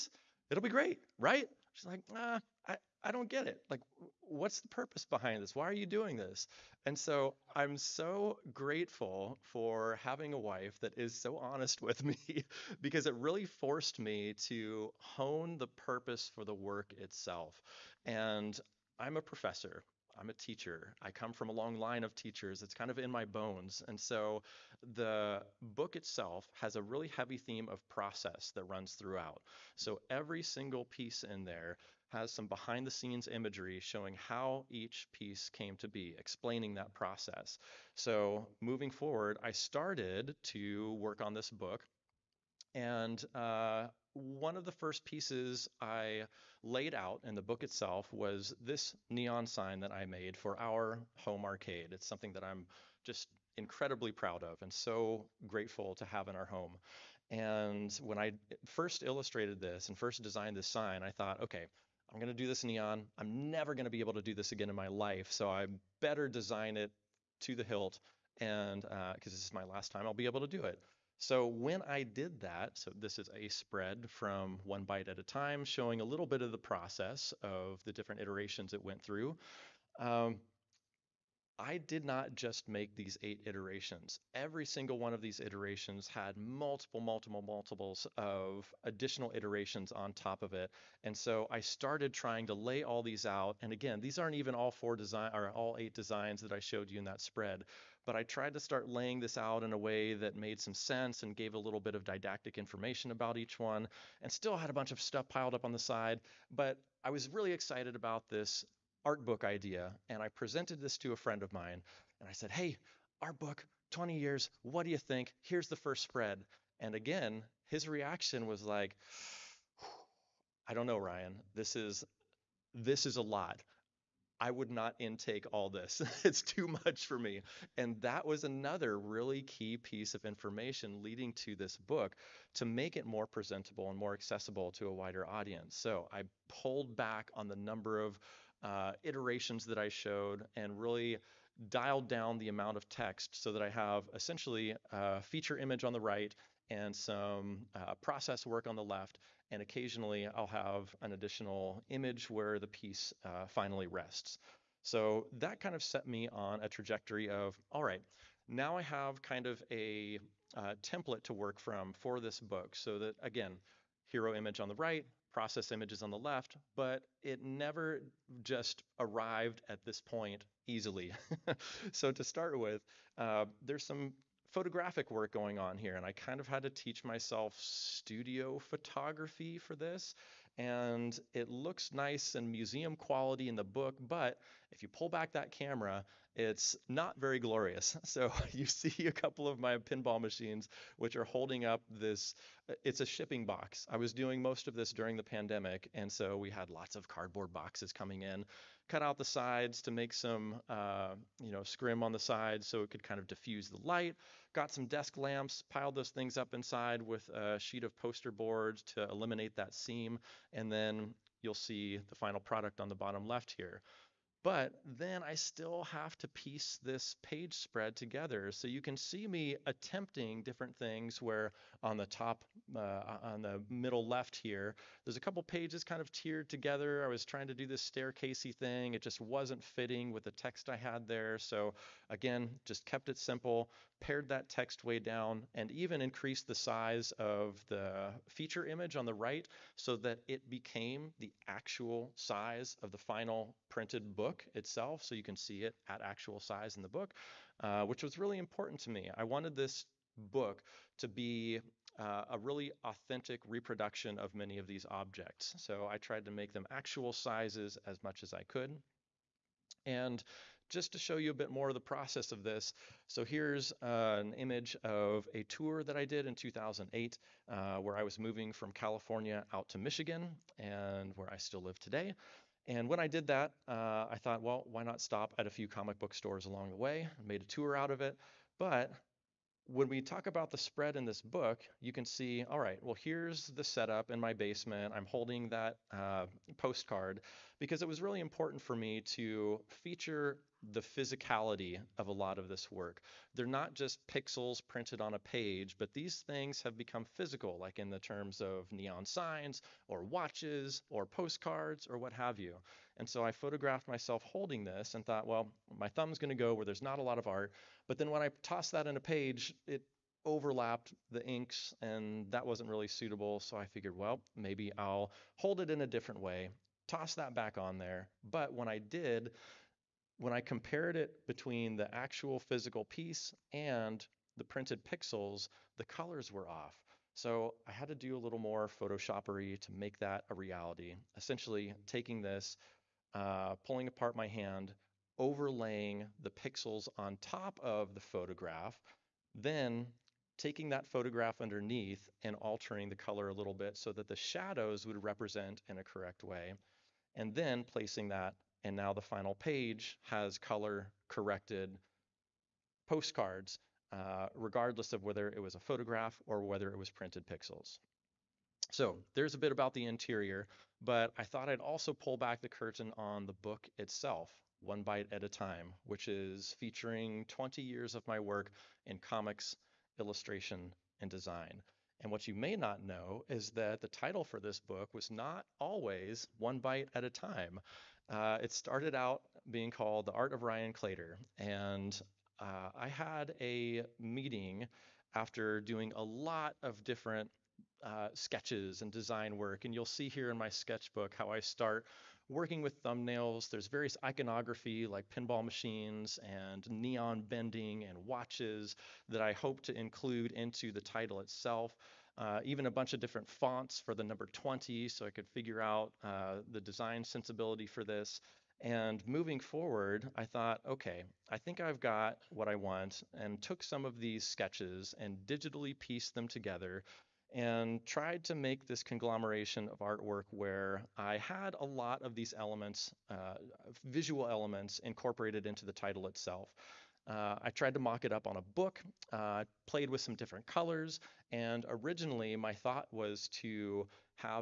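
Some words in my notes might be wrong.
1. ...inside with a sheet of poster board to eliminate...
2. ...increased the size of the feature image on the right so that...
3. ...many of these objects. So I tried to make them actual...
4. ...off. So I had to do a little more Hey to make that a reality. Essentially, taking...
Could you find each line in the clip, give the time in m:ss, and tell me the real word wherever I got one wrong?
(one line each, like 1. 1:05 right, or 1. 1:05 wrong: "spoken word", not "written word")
1. 3:26 right
2. 3:56 right
3. 4:14 right
4. 5:26 wrong: "Photoshopery", not "Hey".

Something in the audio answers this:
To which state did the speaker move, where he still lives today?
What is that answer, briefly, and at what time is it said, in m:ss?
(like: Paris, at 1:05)
Michigan, at 4:29.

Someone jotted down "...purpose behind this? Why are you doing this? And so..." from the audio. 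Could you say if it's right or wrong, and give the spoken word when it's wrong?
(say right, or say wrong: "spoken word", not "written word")
right.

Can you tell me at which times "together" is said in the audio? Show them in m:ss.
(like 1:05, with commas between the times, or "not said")
3:37, 3:46, 6:56.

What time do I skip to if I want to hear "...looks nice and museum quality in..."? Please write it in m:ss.
3:01.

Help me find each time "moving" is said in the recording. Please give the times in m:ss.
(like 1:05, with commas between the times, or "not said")
0:38, 4:28, 6:49.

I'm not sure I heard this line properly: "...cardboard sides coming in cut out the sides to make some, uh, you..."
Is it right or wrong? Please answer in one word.
wrong.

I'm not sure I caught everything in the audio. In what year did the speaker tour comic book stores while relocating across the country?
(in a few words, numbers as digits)
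2008.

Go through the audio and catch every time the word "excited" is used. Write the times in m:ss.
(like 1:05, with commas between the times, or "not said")
1:47.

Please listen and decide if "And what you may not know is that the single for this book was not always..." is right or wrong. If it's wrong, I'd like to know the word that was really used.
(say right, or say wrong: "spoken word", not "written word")
wrong: "title", not "single".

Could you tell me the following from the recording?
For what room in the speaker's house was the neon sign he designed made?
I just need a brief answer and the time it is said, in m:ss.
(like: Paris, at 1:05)
home arcade, at 0:51.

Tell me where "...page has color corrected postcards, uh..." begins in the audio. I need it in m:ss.
5:49.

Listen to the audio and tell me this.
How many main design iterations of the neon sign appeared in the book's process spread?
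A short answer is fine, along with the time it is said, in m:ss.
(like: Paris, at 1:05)
8, at 1:23.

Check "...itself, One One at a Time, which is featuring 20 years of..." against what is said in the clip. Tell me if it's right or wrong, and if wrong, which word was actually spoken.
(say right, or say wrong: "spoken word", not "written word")
wrong: "Bite", not "One".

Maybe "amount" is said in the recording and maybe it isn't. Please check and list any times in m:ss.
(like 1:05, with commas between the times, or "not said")
2:22.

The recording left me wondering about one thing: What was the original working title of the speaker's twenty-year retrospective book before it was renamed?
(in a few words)
The Art of Ryan Claytor.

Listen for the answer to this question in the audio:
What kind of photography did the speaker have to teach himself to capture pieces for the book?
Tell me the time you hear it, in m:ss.
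2:57.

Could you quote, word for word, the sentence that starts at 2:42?
So that again, hero image on the right, process images on the left, but it never just arrived at this point easily.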